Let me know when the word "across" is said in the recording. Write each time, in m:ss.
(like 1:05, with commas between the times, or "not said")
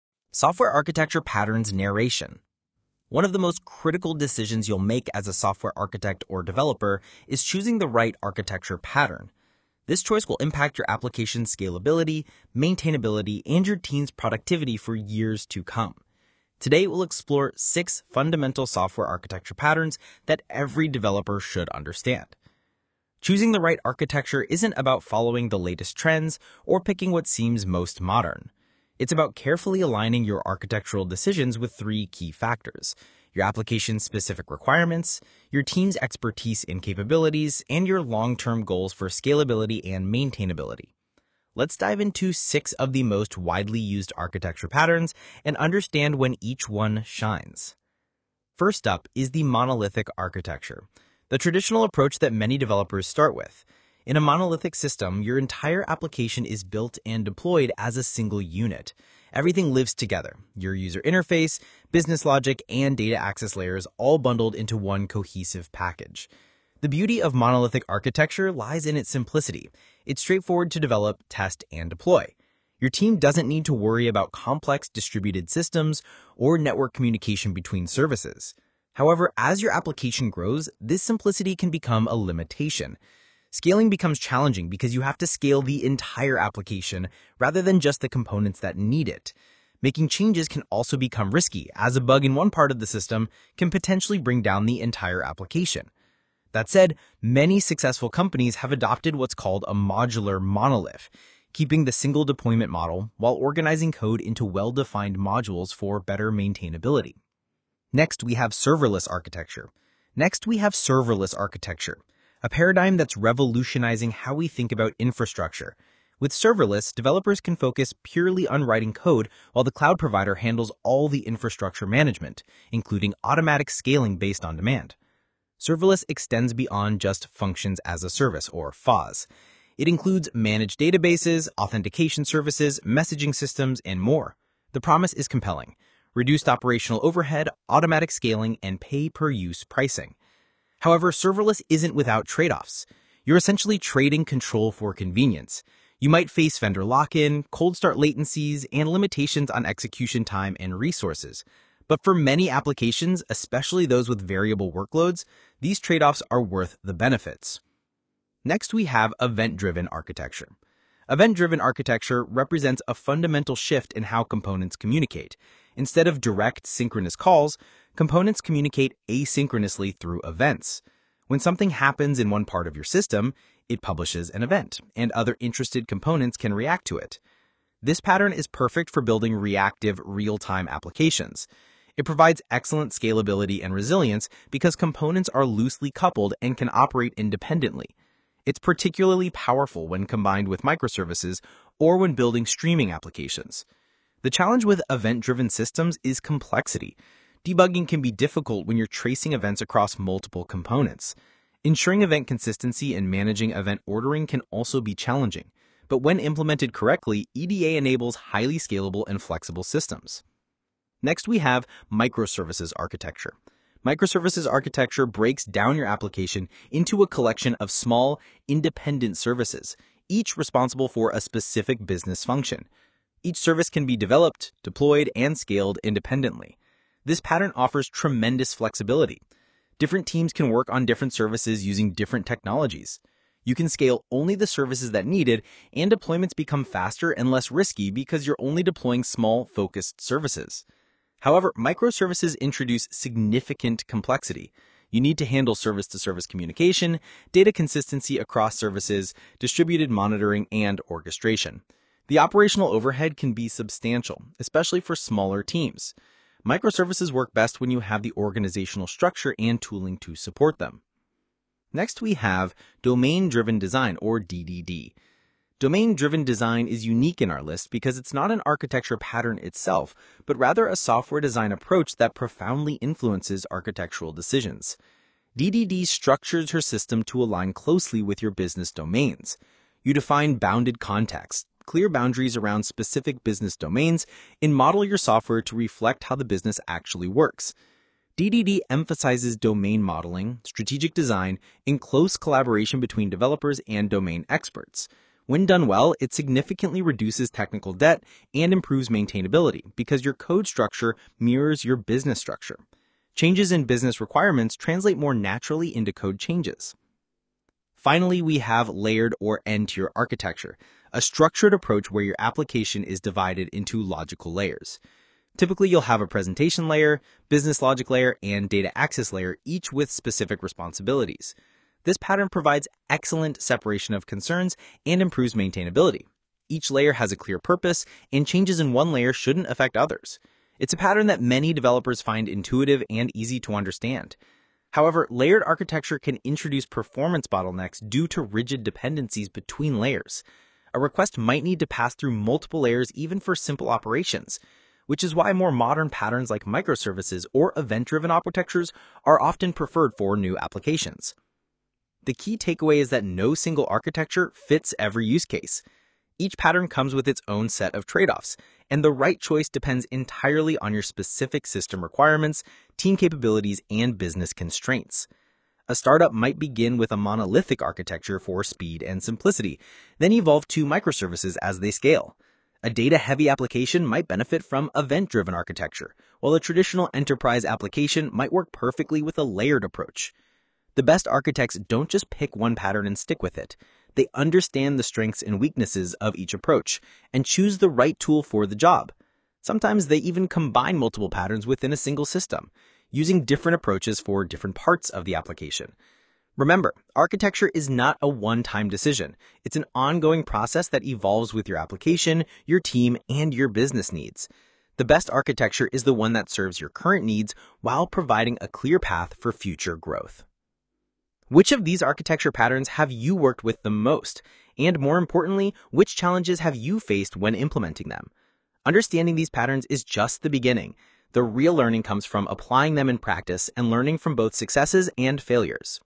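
3:19, 4:08.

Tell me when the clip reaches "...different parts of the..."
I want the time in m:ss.
6:34.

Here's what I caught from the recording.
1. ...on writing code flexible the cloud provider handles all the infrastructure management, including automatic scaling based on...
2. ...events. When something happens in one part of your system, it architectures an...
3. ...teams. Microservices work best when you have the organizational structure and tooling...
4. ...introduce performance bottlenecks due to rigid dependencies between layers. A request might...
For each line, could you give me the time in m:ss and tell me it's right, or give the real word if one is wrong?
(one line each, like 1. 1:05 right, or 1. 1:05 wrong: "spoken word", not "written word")
1. 1:58 wrong: "while", not "flexible"
2. 2:50 wrong: "publishes", not "architectures"
3. 4:15 right
4. 5:36 right.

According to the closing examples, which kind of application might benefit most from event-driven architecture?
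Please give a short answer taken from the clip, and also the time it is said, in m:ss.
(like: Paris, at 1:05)
A data-heavy application, at 6:12.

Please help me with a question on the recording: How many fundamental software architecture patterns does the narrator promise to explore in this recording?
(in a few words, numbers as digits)
6.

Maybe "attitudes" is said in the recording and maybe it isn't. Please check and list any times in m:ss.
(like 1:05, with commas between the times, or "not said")
not said.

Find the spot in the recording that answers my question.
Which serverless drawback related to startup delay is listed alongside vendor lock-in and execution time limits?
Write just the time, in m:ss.
2:27.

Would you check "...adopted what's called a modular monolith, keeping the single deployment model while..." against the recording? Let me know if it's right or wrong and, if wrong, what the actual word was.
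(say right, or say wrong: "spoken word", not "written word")
right.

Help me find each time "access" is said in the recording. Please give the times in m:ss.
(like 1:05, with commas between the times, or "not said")
1:03, 5:18.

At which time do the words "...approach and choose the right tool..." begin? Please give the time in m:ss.
6:26.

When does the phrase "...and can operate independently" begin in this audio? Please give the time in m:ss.
3:06.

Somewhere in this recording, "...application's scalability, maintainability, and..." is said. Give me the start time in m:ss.
0:10.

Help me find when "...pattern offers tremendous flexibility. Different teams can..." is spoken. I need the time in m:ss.
3:47.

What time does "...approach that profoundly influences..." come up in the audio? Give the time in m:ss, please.
4:31.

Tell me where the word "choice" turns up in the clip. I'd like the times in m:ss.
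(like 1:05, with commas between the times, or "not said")
0:10, 5:59.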